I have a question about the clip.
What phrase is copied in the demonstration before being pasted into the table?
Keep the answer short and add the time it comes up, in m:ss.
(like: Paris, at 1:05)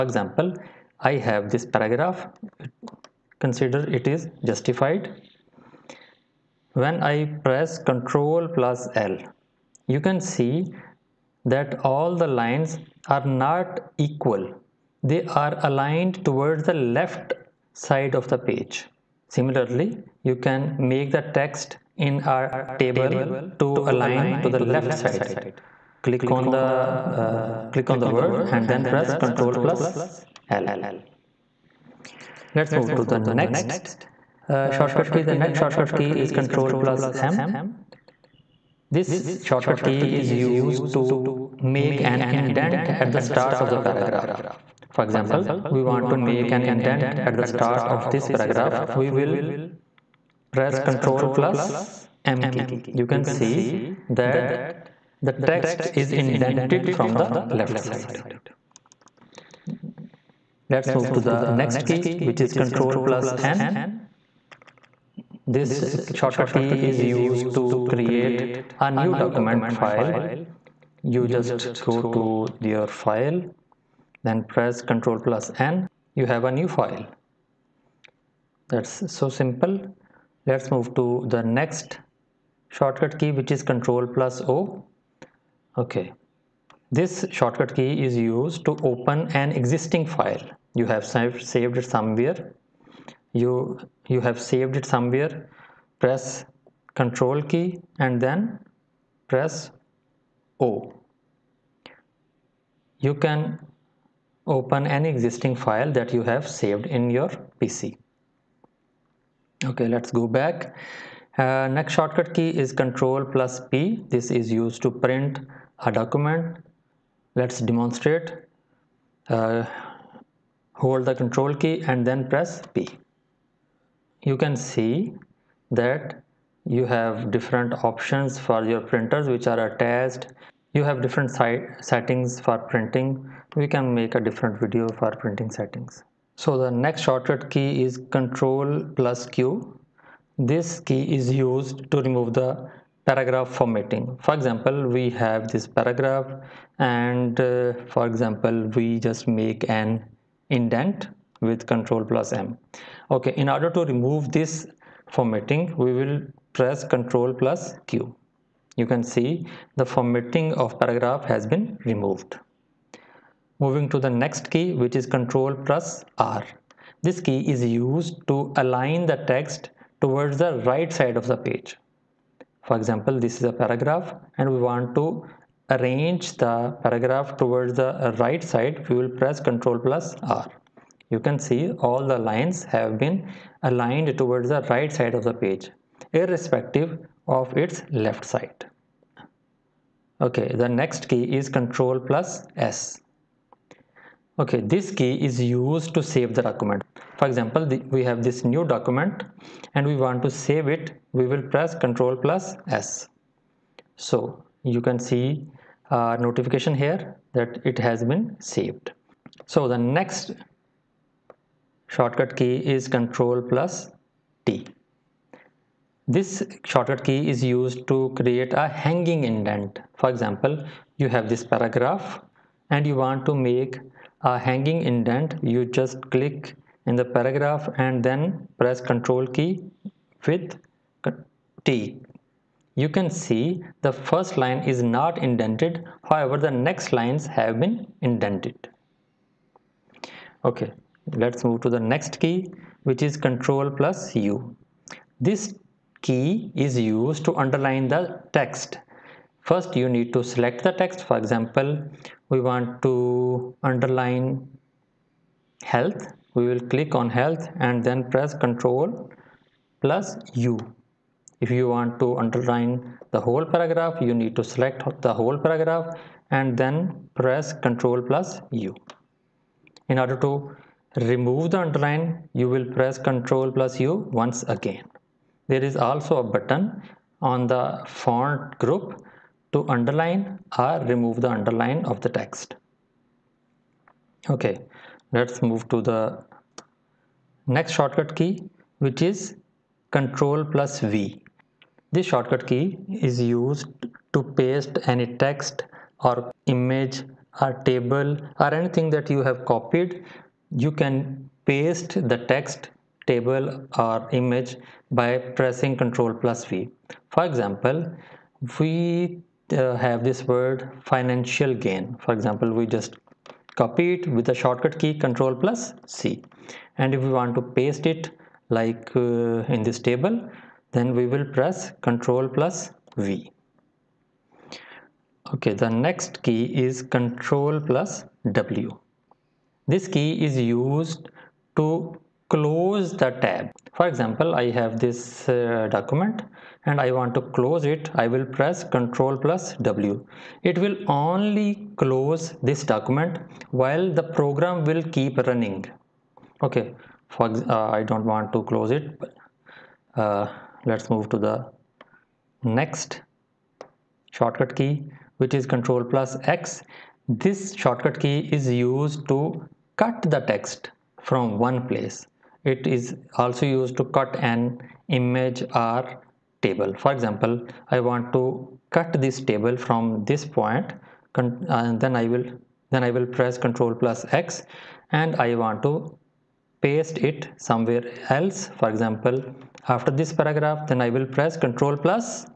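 financial gain, at 5:10.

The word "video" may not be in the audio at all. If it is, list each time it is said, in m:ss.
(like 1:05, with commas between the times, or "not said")
2:14.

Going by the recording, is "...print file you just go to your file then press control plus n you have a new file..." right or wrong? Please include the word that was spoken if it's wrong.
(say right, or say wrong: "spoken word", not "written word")
wrong: "document", not "print".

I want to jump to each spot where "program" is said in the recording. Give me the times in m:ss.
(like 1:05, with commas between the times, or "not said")
5:44.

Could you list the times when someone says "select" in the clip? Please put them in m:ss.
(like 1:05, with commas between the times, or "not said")
4:10, 4:24.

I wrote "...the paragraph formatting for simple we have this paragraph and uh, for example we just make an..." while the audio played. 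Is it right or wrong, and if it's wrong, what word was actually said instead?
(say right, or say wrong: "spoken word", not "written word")
wrong: "example", not "simple".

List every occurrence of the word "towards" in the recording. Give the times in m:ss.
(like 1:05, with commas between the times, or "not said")
0:16, 2:50, 2:57, 3:04.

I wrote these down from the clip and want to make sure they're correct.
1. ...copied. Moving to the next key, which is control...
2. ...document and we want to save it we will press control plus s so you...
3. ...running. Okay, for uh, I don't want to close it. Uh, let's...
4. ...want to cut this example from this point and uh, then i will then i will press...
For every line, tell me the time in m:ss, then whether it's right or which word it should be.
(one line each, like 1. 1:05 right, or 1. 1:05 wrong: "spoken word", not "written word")
1. 2:41 wrong: "removed", not "copied"
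2. 3:18 right
3. 5:45 right
4. 6:07 wrong: "table", not "example".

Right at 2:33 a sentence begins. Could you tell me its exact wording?
Okay, in order to remove this formatting, we will press control plus Q.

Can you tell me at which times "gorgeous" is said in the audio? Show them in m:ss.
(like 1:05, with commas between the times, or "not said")
not said.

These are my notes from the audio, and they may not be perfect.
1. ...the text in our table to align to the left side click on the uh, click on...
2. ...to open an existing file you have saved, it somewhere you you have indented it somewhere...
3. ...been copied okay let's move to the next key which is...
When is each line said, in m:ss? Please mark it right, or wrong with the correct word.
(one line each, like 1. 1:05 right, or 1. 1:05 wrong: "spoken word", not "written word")
1. 0:21 right
2. 1:28 wrong: "saved", not "indented"
3. 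3:57 wrong: "indented", not "copied".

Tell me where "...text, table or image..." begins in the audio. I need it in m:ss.
5:02.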